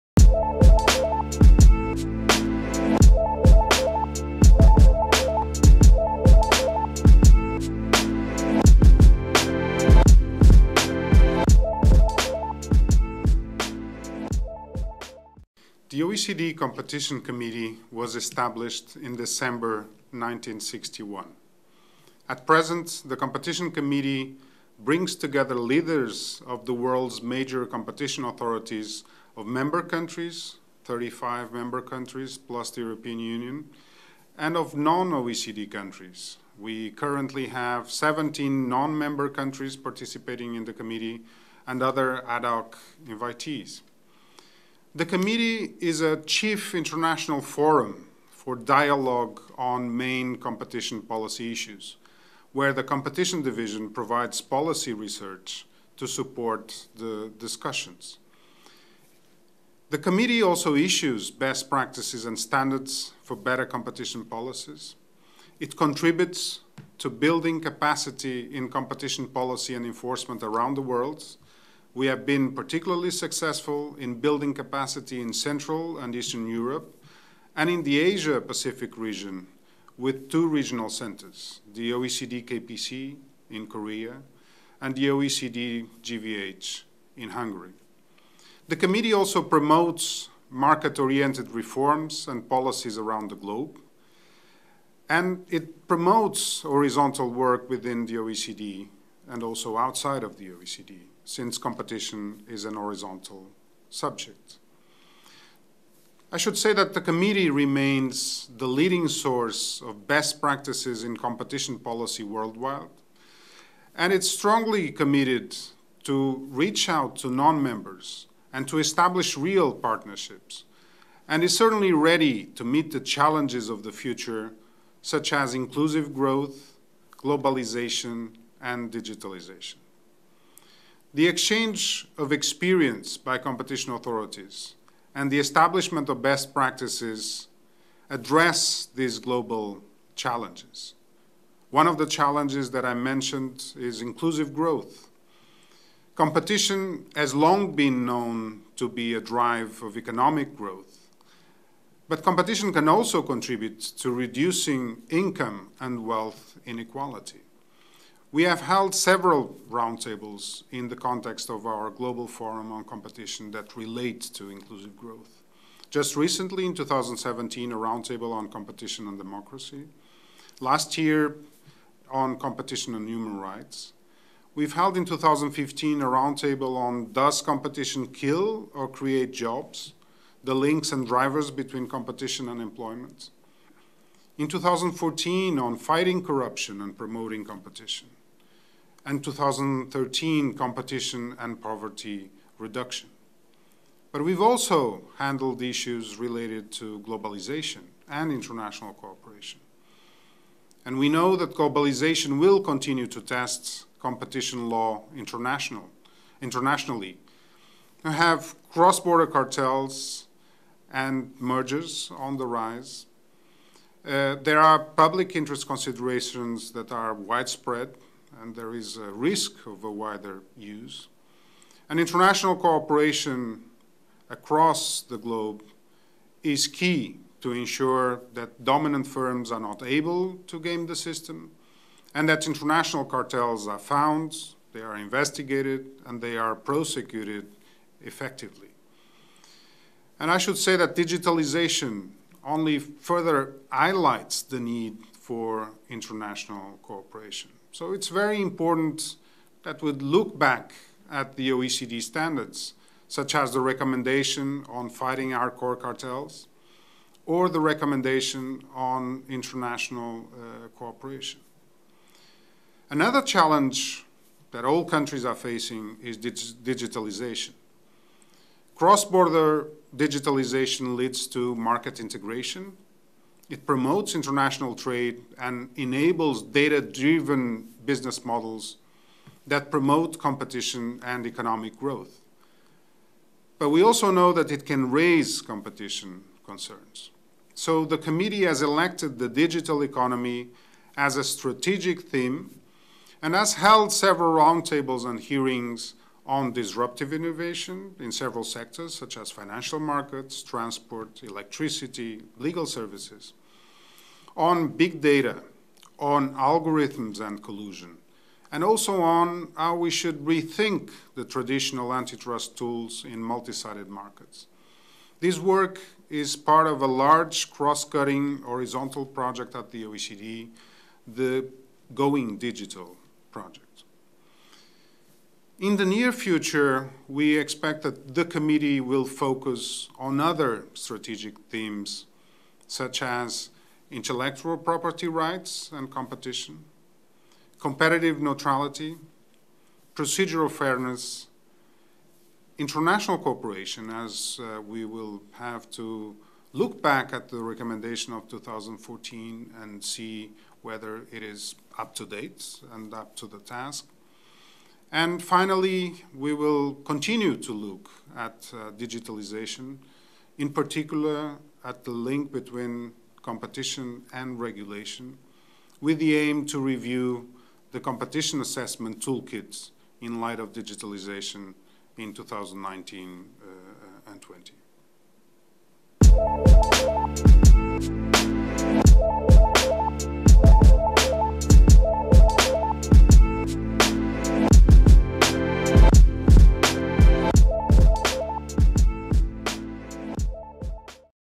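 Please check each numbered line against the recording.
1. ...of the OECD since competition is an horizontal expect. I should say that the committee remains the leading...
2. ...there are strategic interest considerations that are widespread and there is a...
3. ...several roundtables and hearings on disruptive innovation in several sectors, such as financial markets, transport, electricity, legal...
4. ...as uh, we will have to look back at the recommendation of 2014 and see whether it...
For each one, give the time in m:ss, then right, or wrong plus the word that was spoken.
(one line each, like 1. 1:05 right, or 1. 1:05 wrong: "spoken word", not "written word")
1. 1:40 wrong: "subject", not "expect"
2. 3:34 wrong: "public", not "strategic"
3. 4:53 right
4. 5:43 right.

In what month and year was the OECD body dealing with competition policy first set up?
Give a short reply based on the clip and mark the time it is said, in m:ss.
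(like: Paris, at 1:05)
December 1961, at 0:19.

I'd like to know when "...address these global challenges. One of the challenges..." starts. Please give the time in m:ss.
2:18.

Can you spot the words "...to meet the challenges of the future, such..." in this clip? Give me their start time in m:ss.
2:02.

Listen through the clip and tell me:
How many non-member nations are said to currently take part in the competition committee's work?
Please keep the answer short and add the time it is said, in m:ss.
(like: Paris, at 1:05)
17, at 0:37.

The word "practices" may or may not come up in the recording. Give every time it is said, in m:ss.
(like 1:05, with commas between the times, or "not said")
1:01, 1:50, 2:16.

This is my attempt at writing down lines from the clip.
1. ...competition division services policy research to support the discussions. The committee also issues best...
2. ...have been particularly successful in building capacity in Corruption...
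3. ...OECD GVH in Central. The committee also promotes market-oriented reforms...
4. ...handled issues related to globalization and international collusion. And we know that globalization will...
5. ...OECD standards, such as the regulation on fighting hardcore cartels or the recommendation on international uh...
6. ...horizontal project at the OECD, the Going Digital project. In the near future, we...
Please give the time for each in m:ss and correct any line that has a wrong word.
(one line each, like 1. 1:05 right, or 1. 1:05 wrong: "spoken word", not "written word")
1. 0:52 wrong: "provides", not "services"
2. 1:12 wrong: "Central", not "Corruption"
3. 1:25 wrong: "Hungary", not "Central"
4. 3:15 wrong: "cooperation", not "collusion"
5. 4:11 wrong: "recommendation", not "regulation"
6. 5:18 right.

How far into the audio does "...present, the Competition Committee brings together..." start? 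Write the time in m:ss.
0:22.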